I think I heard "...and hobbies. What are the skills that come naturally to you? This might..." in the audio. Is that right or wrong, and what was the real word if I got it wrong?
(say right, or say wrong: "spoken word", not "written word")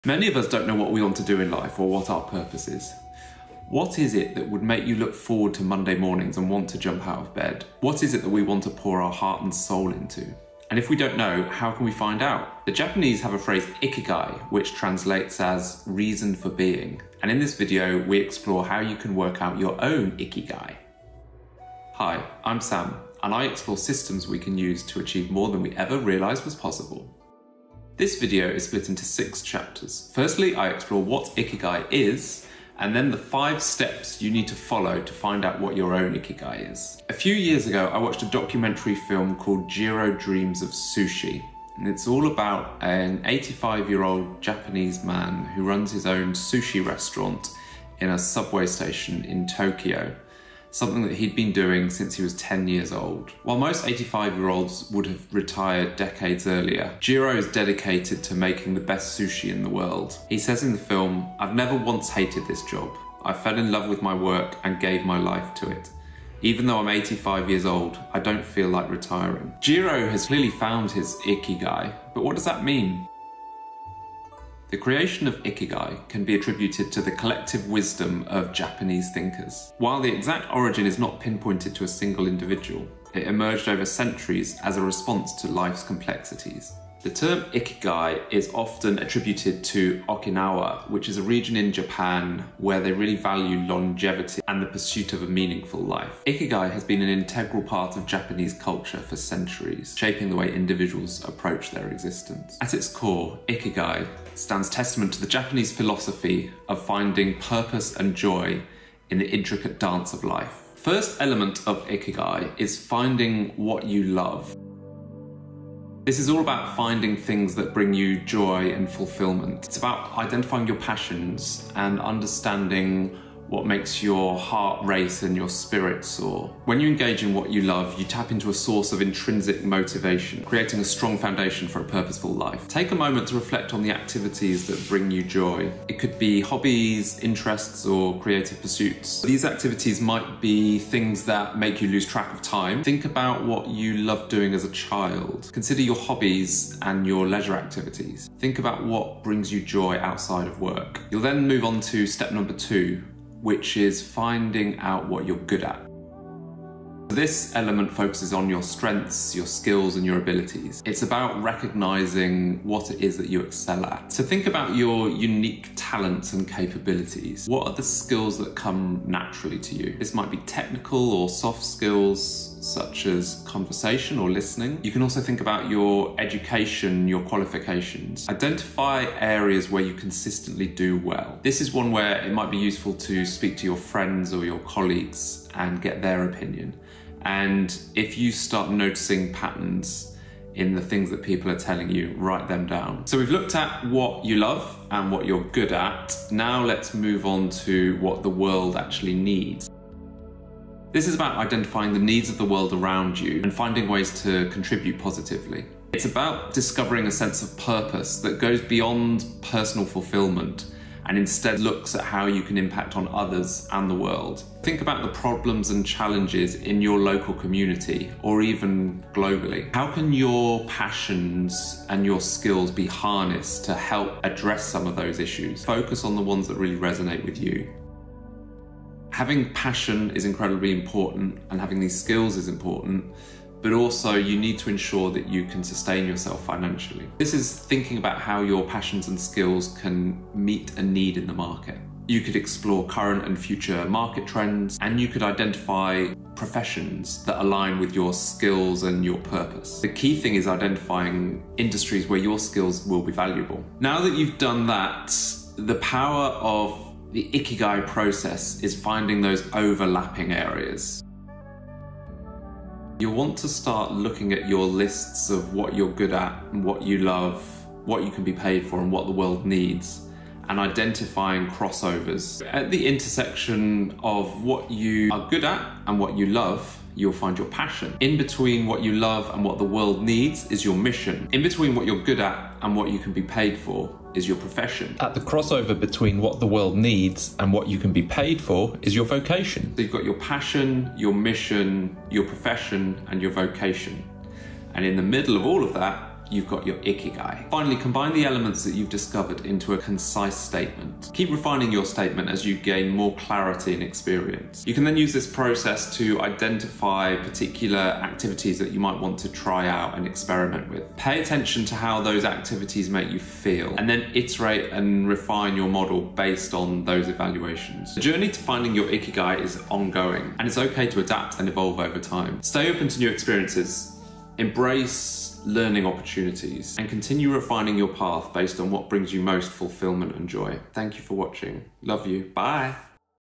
wrong: "capabilities", not "hobbies".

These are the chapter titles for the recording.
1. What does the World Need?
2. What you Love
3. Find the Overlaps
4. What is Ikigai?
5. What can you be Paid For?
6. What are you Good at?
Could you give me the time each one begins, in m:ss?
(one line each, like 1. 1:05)
1. 3:20
2. 1:54
3. 4:23
4. 1:14
5. 3:38
6. 2:36.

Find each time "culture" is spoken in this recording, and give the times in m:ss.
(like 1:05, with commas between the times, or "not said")
1:38.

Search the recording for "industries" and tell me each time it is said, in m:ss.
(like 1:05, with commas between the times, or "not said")
4:11.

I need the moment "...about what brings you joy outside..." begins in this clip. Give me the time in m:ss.
2:28.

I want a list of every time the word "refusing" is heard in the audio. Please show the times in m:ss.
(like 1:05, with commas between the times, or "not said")
not said.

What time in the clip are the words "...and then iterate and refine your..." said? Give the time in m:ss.
5:13.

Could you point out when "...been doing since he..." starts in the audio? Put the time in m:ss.
0:51.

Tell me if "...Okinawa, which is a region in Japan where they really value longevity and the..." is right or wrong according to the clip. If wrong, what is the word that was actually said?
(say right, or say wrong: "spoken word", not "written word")
right.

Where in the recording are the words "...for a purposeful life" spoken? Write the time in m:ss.
2:11.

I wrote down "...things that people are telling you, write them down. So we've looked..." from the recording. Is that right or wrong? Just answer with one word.
right.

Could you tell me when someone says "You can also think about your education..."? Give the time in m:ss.
2:54.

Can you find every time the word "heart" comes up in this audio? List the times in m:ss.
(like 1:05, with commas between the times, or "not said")
0:09, 2:04.